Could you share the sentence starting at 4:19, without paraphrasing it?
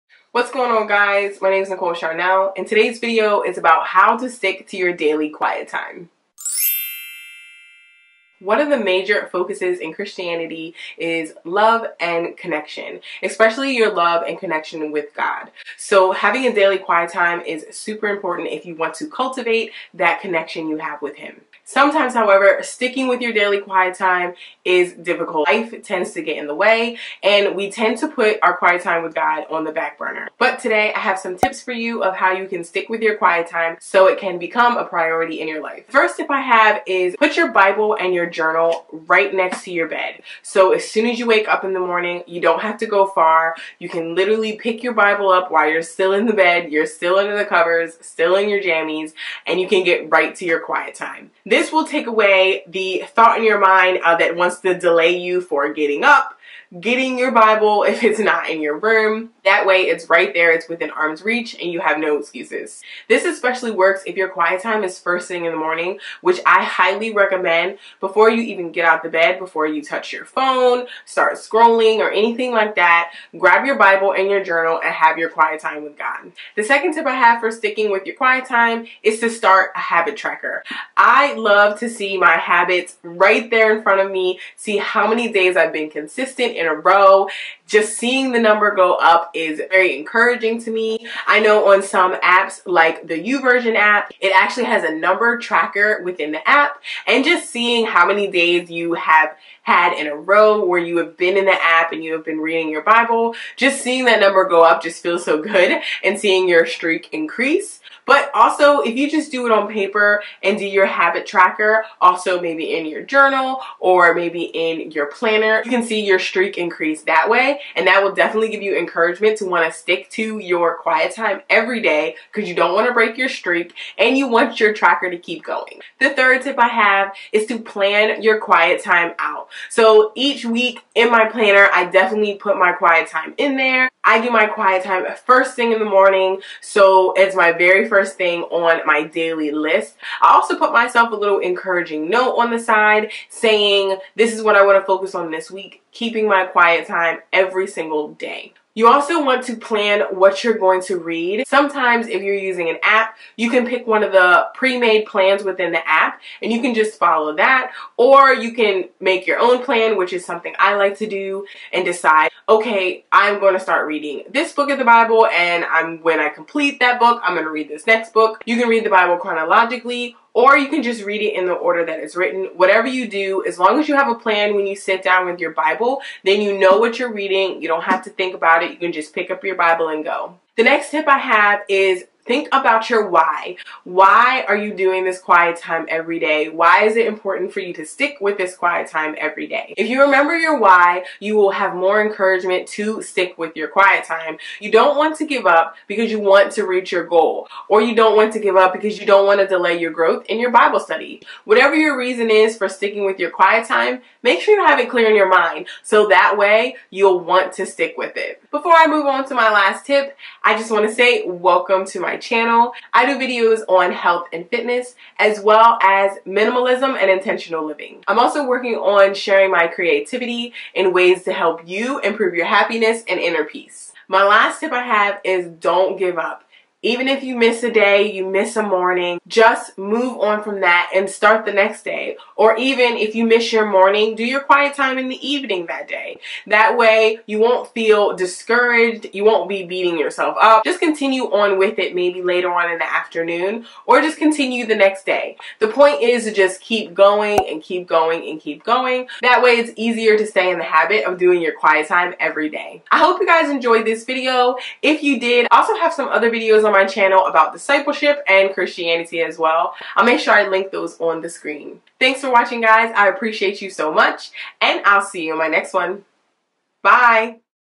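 I'll make sure I link those on the screen.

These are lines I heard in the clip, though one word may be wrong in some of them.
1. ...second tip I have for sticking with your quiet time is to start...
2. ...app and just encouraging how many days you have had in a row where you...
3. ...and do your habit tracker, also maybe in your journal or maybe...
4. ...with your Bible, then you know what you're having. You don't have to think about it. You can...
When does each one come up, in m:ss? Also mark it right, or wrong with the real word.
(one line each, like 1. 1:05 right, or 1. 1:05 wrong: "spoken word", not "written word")
1. 1:16 right
2. 1:36 wrong: "seeing", not "encouraging"
3. 1:50 right
4. 2:55 wrong: "reading", not "having".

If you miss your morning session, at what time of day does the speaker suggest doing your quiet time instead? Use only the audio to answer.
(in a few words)
In the evening.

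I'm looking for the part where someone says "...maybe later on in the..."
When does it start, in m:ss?
4:01.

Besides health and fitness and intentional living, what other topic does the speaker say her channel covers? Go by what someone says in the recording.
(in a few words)
Minimalism.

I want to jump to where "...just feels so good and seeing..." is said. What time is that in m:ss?
1:44.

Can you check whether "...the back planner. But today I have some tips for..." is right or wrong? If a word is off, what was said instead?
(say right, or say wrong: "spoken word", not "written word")
wrong: "burner", not "planner".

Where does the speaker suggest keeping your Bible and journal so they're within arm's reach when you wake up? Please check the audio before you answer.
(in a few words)
Next to your bed.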